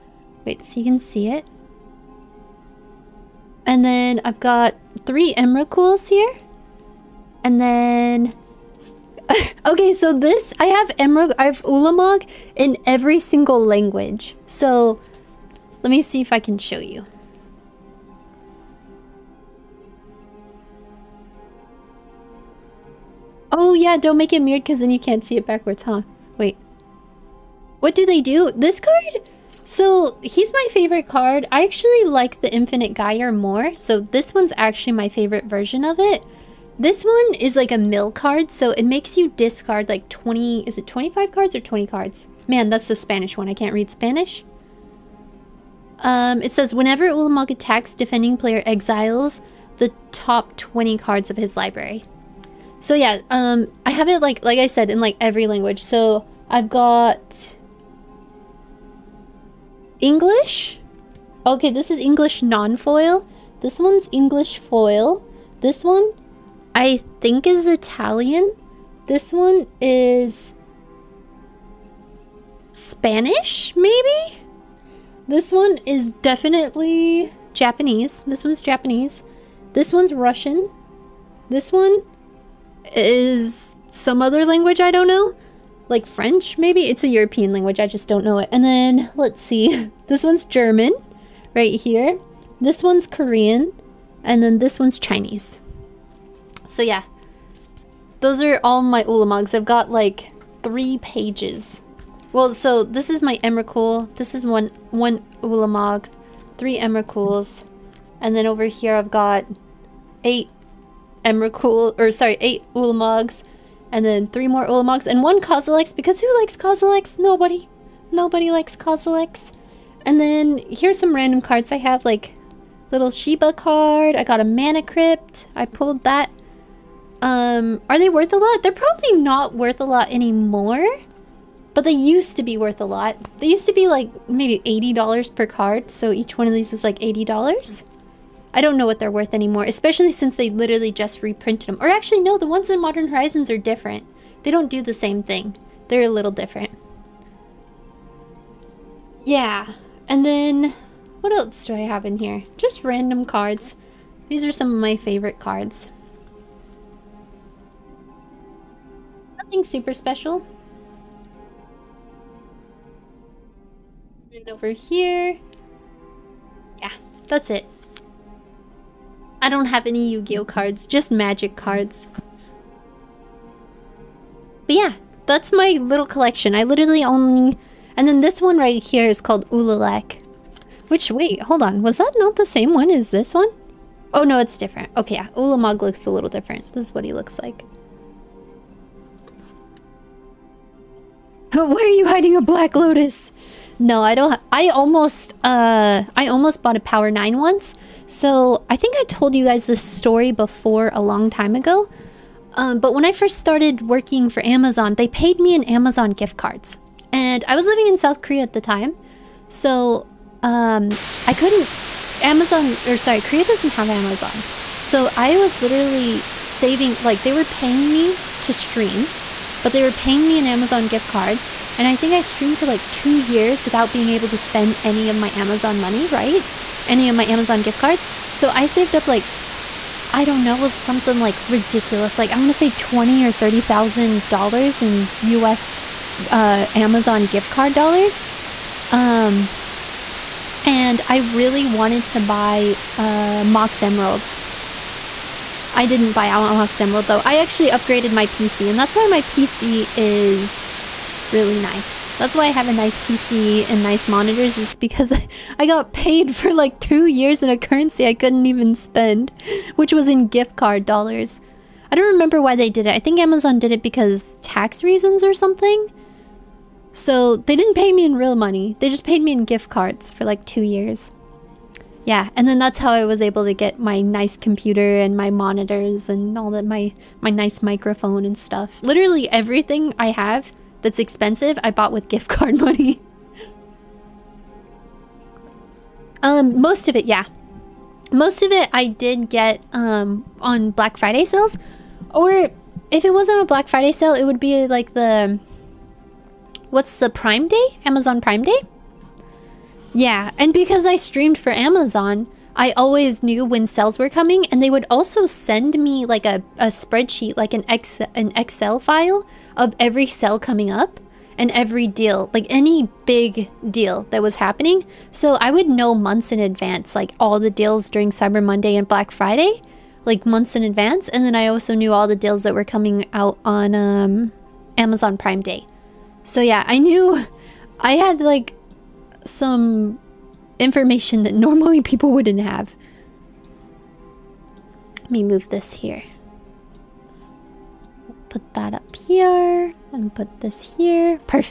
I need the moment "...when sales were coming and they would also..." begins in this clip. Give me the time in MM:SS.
05:03.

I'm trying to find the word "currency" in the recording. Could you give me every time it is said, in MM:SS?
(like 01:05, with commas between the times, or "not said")
04:17.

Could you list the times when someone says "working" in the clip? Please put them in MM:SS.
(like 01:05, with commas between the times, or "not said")
03:23.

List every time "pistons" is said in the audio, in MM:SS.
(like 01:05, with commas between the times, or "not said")
not said.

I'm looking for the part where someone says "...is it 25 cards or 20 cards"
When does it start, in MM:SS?
00:40.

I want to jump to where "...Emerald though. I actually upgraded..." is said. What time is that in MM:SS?
04:06.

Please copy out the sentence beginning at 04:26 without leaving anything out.
So they didn't pay me in real money.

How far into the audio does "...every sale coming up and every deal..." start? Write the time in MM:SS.
05:09.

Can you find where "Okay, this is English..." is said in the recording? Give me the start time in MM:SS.
01:01.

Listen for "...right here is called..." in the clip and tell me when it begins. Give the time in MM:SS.
02:58.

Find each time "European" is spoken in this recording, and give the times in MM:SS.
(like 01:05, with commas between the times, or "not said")
01:27.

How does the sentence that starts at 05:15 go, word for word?
So I would know months in advance, like all the deals during Cyber Monday and Black Friday, like months in advance.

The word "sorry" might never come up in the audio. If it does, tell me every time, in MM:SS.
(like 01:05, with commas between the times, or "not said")
01:52, 03:32.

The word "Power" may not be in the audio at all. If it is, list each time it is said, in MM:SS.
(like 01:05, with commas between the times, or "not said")
03:16.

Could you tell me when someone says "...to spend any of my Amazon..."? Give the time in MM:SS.
03:44.